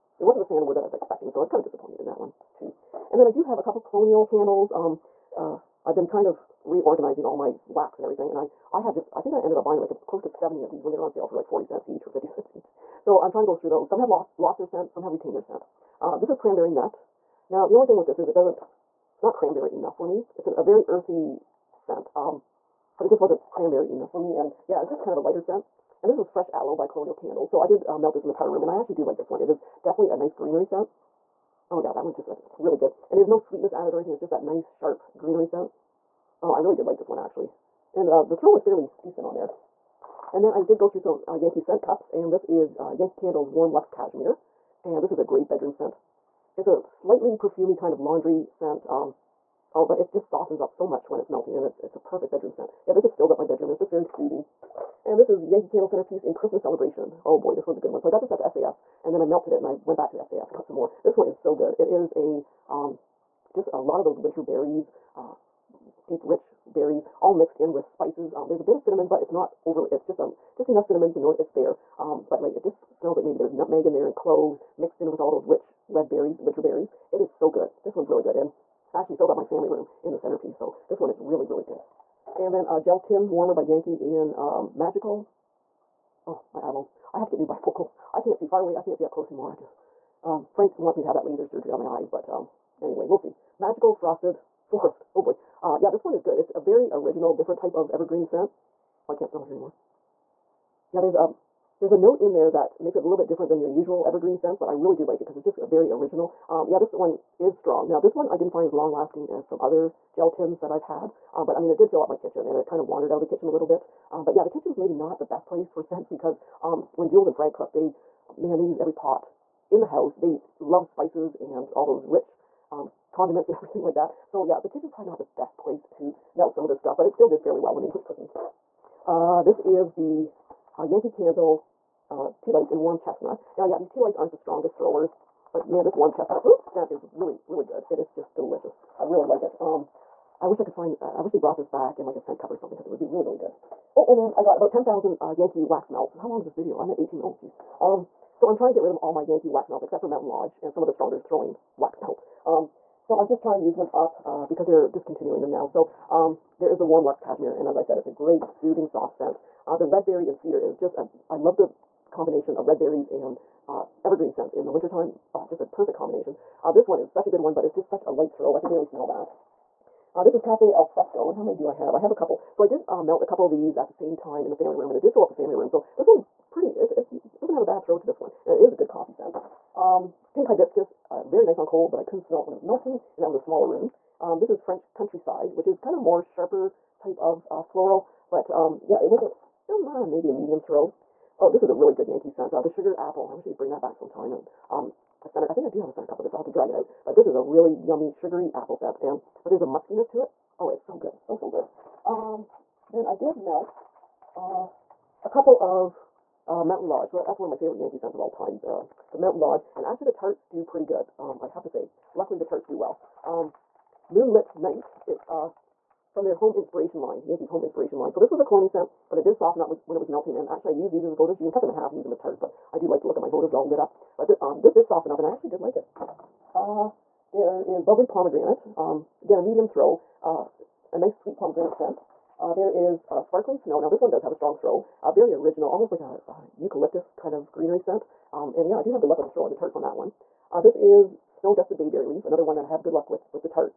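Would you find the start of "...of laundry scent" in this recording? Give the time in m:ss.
0:47.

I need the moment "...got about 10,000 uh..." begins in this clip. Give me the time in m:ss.
2:24.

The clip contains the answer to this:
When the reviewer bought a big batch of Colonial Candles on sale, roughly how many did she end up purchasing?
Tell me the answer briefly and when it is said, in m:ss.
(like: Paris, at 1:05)
70, at 0:10.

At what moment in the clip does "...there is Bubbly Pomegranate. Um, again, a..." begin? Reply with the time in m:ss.
3:47.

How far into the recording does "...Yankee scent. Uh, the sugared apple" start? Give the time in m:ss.
3:12.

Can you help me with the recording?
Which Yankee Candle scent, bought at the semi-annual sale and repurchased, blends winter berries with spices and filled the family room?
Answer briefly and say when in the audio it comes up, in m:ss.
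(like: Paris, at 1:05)
Christmas Celebration, at 0:56.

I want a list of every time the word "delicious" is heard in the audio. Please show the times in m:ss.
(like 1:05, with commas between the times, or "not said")
2:18.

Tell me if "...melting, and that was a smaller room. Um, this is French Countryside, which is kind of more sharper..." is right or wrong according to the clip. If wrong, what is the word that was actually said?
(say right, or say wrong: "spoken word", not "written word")
right.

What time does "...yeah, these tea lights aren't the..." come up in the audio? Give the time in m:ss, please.
2:13.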